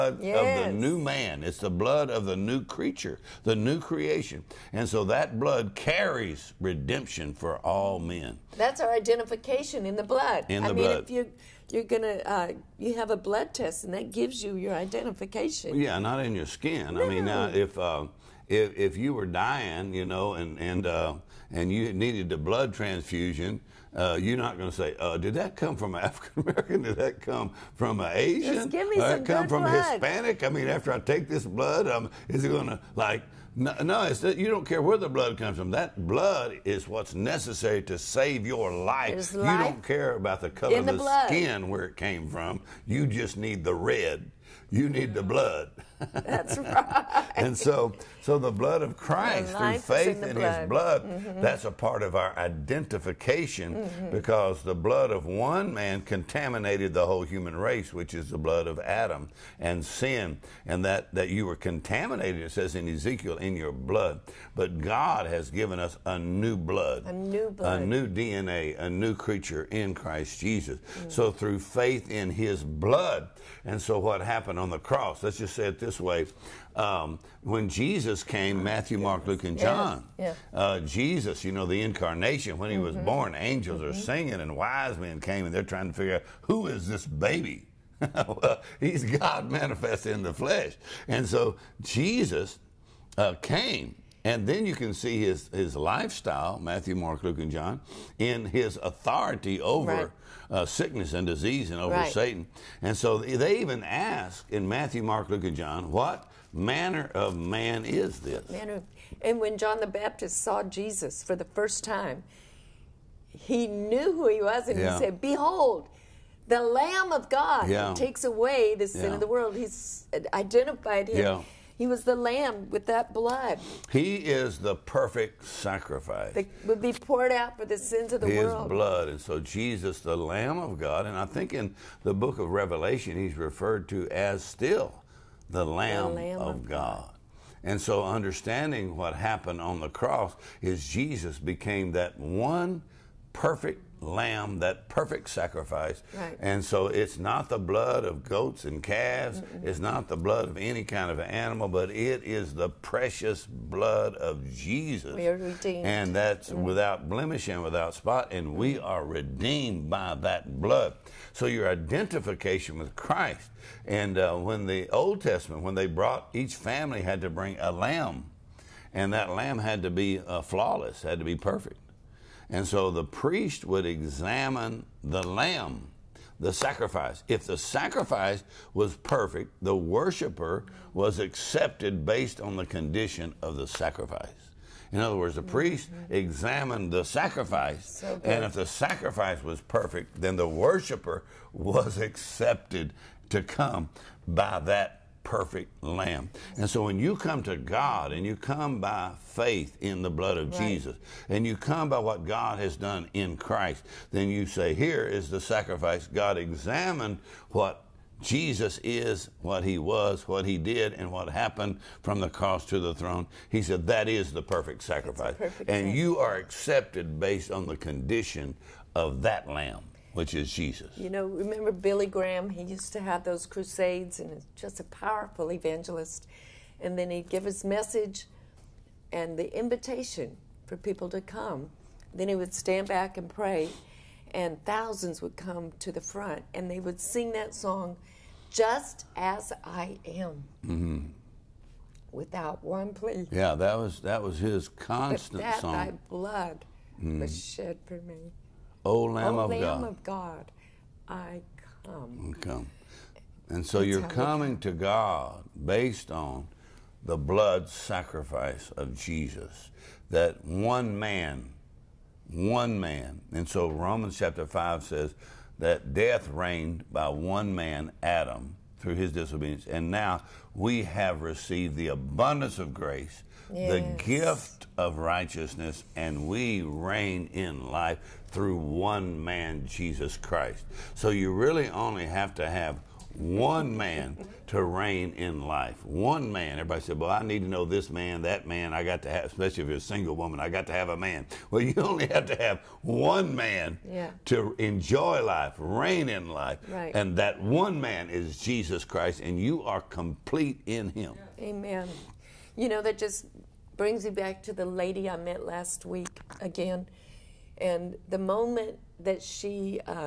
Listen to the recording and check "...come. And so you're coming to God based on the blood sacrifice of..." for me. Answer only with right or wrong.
right.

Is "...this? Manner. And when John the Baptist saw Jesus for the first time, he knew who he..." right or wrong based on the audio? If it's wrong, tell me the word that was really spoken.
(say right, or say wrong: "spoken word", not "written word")
right.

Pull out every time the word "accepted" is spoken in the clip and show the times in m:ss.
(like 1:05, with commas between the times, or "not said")
3:01, 3:11, 3:36.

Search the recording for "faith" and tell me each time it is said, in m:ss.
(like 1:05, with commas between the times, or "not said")
0:49, 1:11, 3:19.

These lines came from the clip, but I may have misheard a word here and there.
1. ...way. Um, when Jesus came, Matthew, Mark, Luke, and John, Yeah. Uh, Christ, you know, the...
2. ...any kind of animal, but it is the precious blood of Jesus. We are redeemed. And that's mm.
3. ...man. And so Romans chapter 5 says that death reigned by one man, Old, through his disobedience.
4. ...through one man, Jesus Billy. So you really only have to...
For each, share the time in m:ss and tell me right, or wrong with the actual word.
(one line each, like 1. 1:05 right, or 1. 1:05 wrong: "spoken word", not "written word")
1. 1:15 wrong: "Jesus", not "Christ"
2. 2:30 right
3. 4:22 wrong: "Adam", not "Old"
4. 4:38 wrong: "Christ", not "Billy".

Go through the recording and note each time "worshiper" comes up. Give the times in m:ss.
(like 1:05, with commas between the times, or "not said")
2:59, 3:10.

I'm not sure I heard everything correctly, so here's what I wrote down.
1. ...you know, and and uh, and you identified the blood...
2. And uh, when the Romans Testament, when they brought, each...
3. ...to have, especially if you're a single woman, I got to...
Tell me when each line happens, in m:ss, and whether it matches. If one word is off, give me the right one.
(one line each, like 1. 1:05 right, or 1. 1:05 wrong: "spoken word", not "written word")
1. 0:19 wrong: "needed", not "identified"
2. 2:43 wrong: "Old", not "Romans"
3. 4:49 right.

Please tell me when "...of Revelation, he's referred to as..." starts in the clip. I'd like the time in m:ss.
2:12.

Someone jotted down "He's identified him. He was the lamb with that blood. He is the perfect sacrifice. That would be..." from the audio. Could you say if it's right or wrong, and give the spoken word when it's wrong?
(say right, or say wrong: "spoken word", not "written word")
right.